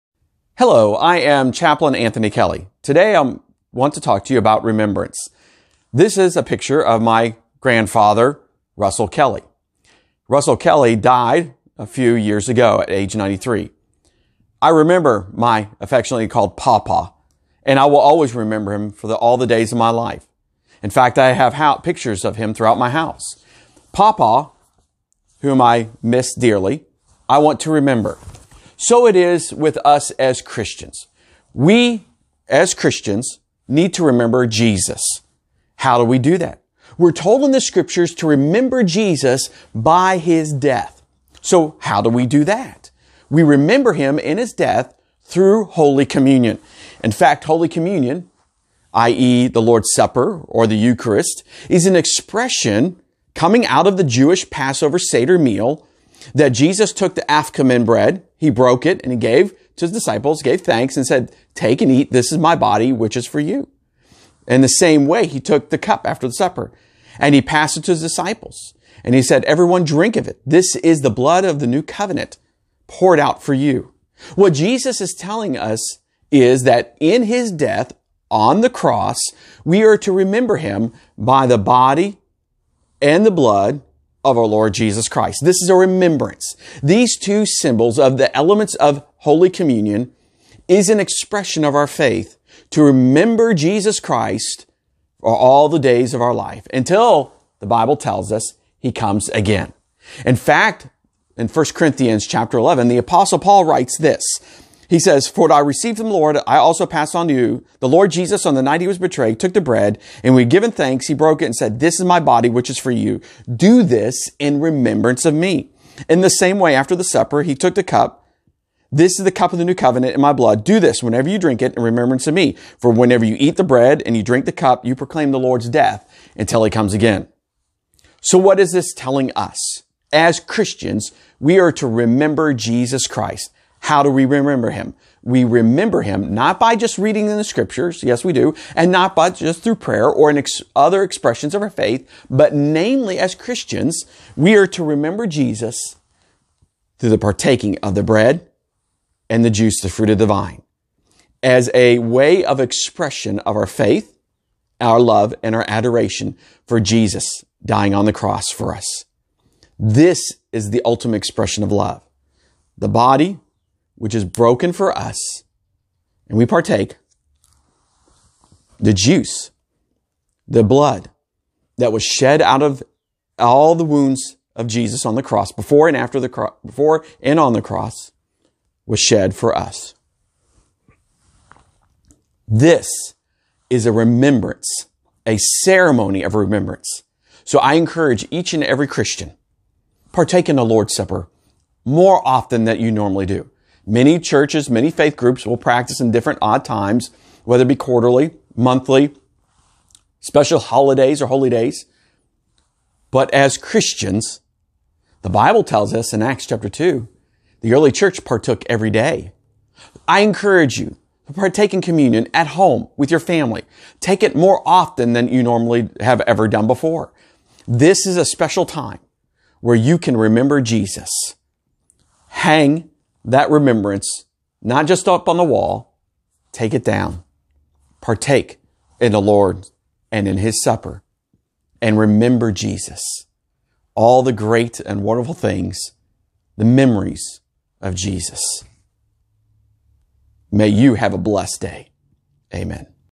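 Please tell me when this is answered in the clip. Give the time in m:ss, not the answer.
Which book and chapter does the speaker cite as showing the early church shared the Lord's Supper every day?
3:26.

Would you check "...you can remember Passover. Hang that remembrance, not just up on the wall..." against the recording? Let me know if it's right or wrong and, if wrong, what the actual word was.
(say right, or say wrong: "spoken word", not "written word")
wrong: "Jesus", not "Passover".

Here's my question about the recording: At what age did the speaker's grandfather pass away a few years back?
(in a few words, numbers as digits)
93.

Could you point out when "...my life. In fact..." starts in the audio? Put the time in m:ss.
0:19.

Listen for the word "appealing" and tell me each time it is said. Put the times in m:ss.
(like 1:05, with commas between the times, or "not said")
not said.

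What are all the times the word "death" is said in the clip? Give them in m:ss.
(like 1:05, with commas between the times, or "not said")
0:40, 0:44, 1:17, 2:05.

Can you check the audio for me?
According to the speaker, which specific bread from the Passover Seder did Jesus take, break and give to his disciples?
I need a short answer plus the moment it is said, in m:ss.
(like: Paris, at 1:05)
afikoman, at 0:57.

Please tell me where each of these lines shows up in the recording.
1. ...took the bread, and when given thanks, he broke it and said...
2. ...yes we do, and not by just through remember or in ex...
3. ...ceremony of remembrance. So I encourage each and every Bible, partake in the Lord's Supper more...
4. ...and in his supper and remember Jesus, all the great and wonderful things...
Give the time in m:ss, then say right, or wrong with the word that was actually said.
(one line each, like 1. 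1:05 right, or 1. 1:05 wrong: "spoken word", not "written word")
1. 1:49 right
2. 2:18 wrong: "prayer", not "remember"
3. 3:05 wrong: "Christian", not "Bible"
4. 3:50 right.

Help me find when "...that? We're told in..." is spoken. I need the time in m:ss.
0:36.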